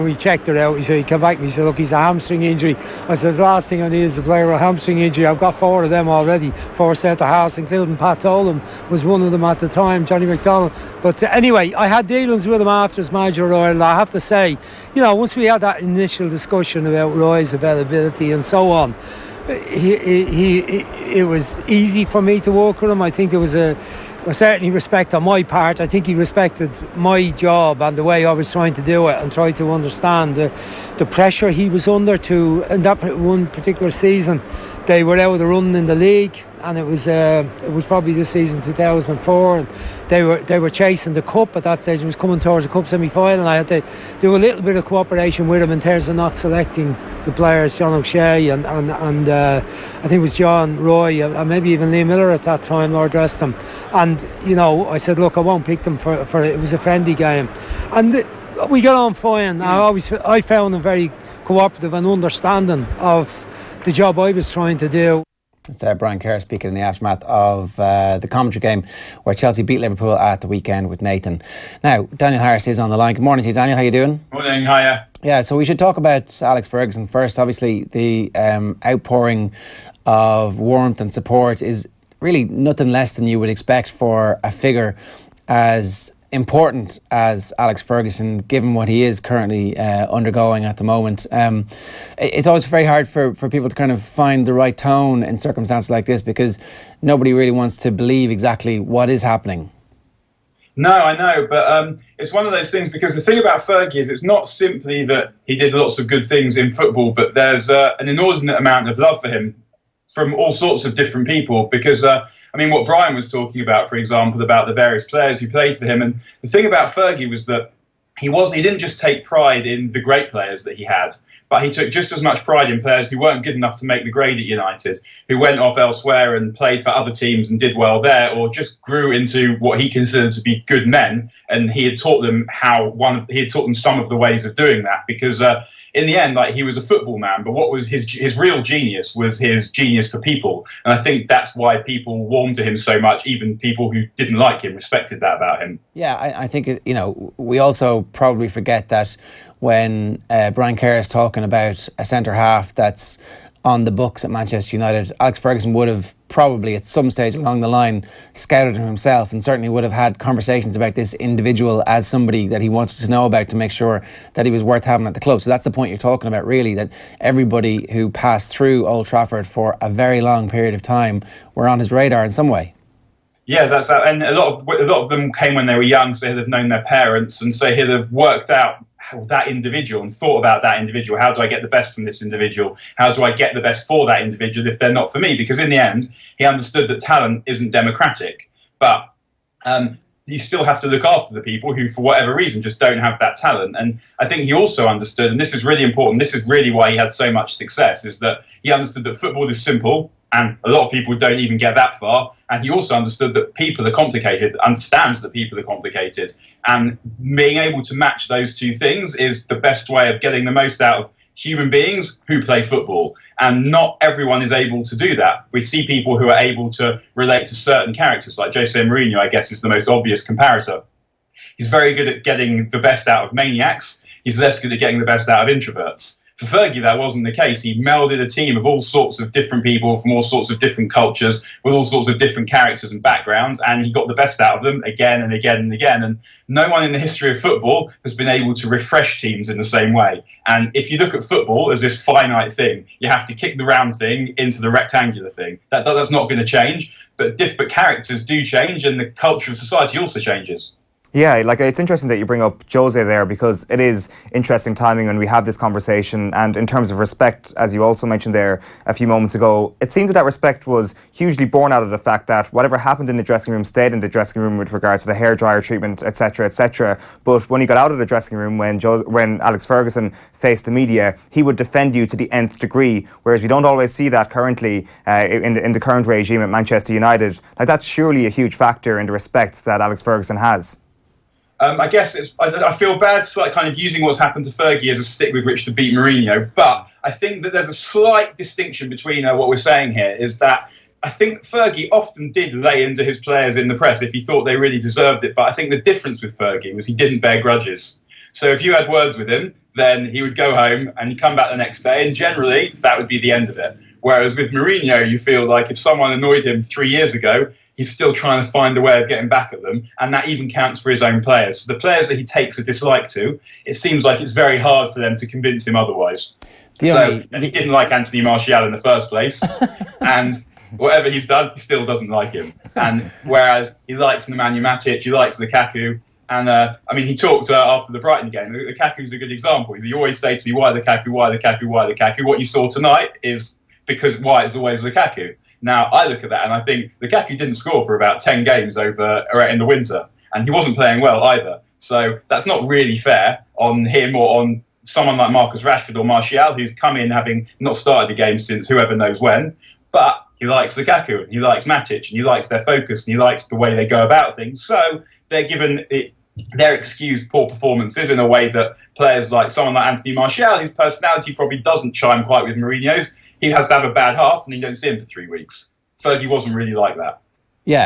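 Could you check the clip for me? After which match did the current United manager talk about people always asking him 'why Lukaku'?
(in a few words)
Brighton.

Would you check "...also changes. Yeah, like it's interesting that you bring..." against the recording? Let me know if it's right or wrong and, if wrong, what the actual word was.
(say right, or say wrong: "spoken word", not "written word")
right.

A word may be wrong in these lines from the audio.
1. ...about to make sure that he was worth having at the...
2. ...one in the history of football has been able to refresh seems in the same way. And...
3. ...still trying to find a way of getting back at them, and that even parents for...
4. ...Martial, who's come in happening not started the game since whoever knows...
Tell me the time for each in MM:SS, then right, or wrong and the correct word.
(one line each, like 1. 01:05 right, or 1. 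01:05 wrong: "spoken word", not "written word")
1. 02:43 right
2. 03:56 wrong: "teams", not "seems"
3. 05:07 wrong: "counts", not "parents"
4. 05:46 wrong: "having", not "happening".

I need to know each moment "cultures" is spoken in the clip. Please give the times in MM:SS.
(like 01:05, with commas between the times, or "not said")
03:50, 04:09.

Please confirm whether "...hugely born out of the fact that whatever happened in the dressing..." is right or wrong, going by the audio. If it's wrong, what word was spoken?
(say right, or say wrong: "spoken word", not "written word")
right.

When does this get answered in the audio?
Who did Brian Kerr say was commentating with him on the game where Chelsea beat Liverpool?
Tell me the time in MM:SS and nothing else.
01:10.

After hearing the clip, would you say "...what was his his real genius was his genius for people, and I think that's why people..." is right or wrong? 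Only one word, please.
right.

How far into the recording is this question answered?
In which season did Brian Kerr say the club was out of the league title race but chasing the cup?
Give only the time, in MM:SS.
00:38.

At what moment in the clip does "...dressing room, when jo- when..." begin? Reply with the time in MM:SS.
04:28.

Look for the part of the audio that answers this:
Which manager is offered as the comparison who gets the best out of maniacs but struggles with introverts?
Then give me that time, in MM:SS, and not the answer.
03:38.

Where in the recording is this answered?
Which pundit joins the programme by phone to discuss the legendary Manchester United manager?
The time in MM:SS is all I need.
01:12.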